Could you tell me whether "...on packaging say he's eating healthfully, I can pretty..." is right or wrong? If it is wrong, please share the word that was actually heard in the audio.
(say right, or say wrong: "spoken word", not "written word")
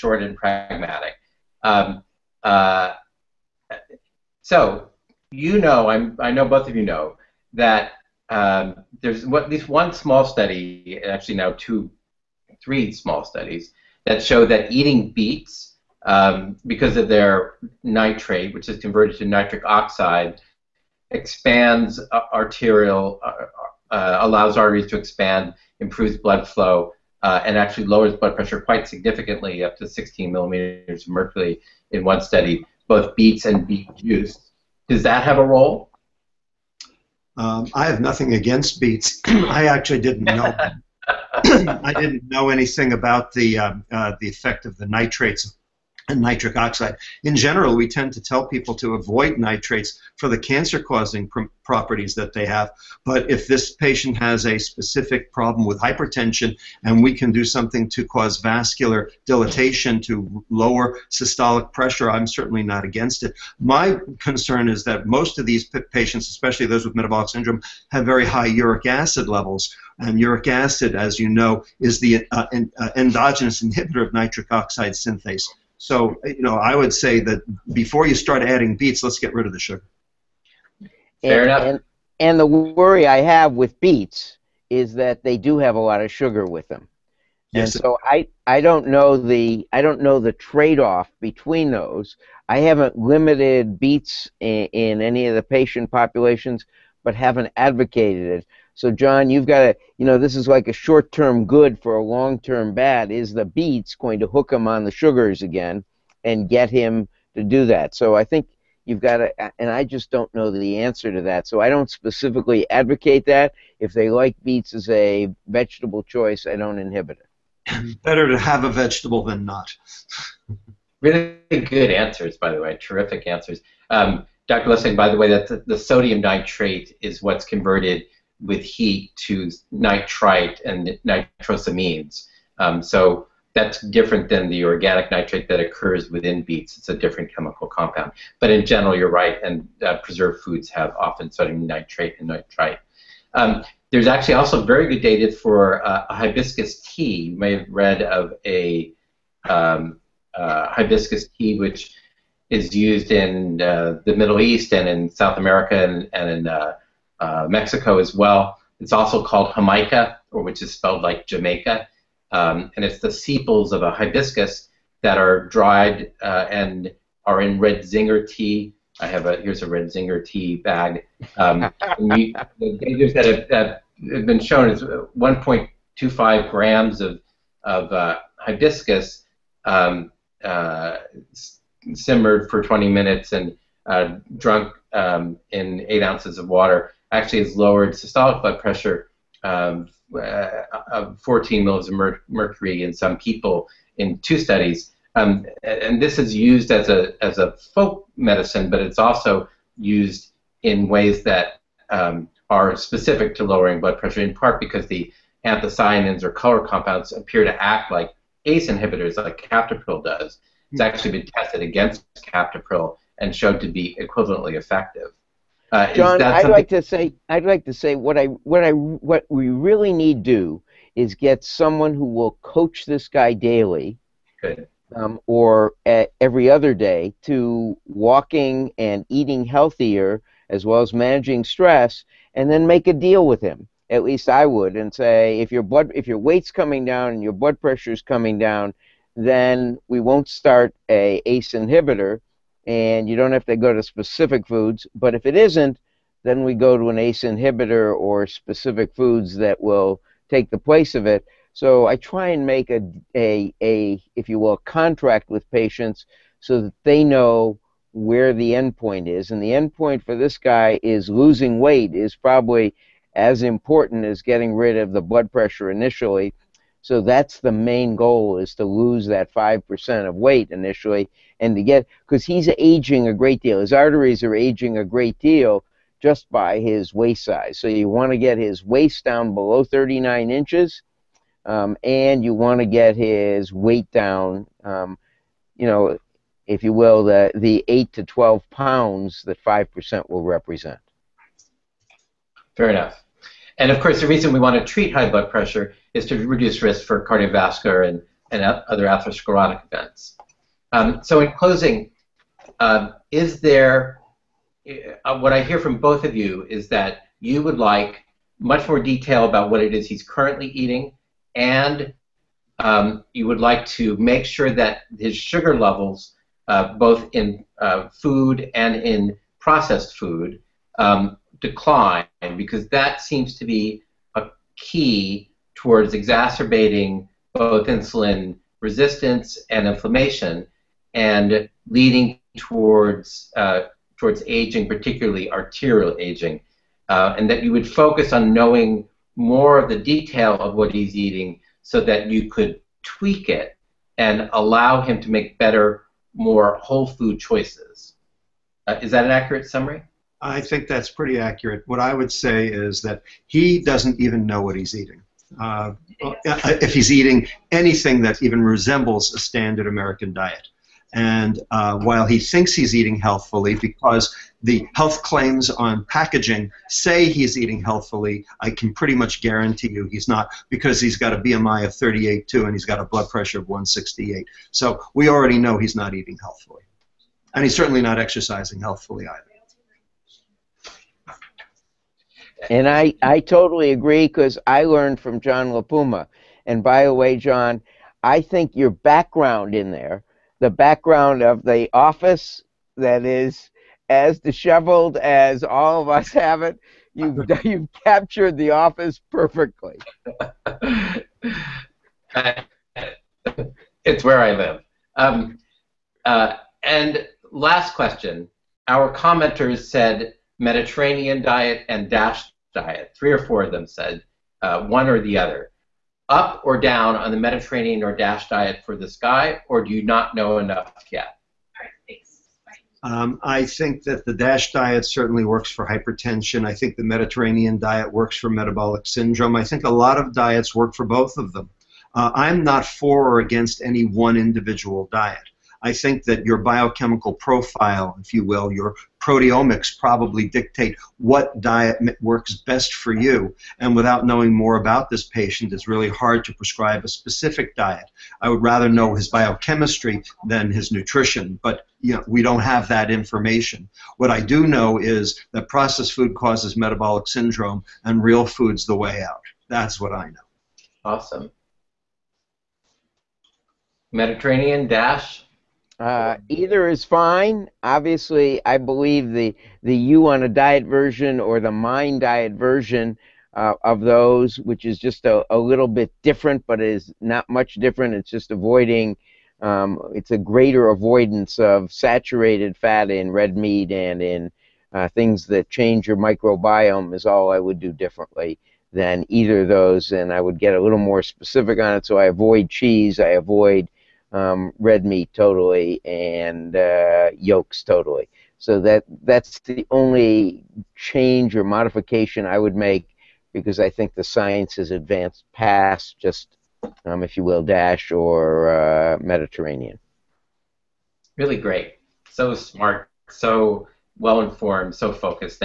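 right.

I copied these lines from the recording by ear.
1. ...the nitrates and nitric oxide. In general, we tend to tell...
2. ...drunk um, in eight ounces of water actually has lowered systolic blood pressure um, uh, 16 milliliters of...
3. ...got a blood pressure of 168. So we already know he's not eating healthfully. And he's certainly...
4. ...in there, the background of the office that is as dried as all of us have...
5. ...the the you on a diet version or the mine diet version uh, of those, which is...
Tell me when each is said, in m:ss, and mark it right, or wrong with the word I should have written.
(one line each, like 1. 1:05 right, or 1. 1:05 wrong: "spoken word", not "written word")
1. 0:44 right
2. 3:04 wrong: "14", not "16"
3. 6:12 right
4. 6:29 wrong: "disheveled", not "dried"
5. 7:49 right.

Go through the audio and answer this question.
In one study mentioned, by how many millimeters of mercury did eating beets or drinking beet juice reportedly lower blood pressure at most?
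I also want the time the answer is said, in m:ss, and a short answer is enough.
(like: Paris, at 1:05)
16, at 0:29.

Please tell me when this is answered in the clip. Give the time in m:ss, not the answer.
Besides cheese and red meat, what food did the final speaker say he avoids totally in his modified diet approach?
8:17.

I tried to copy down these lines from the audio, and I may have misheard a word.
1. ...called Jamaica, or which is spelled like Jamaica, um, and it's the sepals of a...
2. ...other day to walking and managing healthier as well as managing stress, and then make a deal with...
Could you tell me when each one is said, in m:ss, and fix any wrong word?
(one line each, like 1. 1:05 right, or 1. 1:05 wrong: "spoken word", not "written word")
1. 2:39 right
2. 3:46 wrong: "eating", not "managing".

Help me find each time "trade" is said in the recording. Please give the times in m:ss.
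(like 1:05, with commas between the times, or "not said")
1:30.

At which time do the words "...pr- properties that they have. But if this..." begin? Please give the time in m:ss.
0:51.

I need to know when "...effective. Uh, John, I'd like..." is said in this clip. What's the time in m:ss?
3:34.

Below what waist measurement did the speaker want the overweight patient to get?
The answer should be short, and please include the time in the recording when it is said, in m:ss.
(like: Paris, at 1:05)
39 inches, at 4:39.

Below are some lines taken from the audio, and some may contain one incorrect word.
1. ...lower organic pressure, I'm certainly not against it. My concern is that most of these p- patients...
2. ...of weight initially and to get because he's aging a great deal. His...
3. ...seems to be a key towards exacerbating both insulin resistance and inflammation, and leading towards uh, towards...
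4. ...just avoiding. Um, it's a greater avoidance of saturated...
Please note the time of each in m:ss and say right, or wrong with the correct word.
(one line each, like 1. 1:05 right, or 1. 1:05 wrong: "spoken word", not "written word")
1. 1:00 wrong: "systolic", not "organic"
2. 4:30 right
3. 5:23 right
4. 7:58 right.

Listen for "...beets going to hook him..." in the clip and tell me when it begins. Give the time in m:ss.
1:43.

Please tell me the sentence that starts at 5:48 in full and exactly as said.
Uh, is that an accurate summary?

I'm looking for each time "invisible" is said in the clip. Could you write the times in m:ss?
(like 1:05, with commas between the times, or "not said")
not said.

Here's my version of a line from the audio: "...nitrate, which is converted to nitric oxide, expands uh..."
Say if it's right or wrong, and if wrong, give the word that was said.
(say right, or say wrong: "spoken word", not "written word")
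right.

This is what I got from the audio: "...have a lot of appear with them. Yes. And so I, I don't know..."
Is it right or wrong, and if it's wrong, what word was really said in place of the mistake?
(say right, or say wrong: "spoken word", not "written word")
wrong: "sugar", not "appear".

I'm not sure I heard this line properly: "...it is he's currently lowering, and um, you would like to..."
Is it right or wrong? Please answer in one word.
wrong.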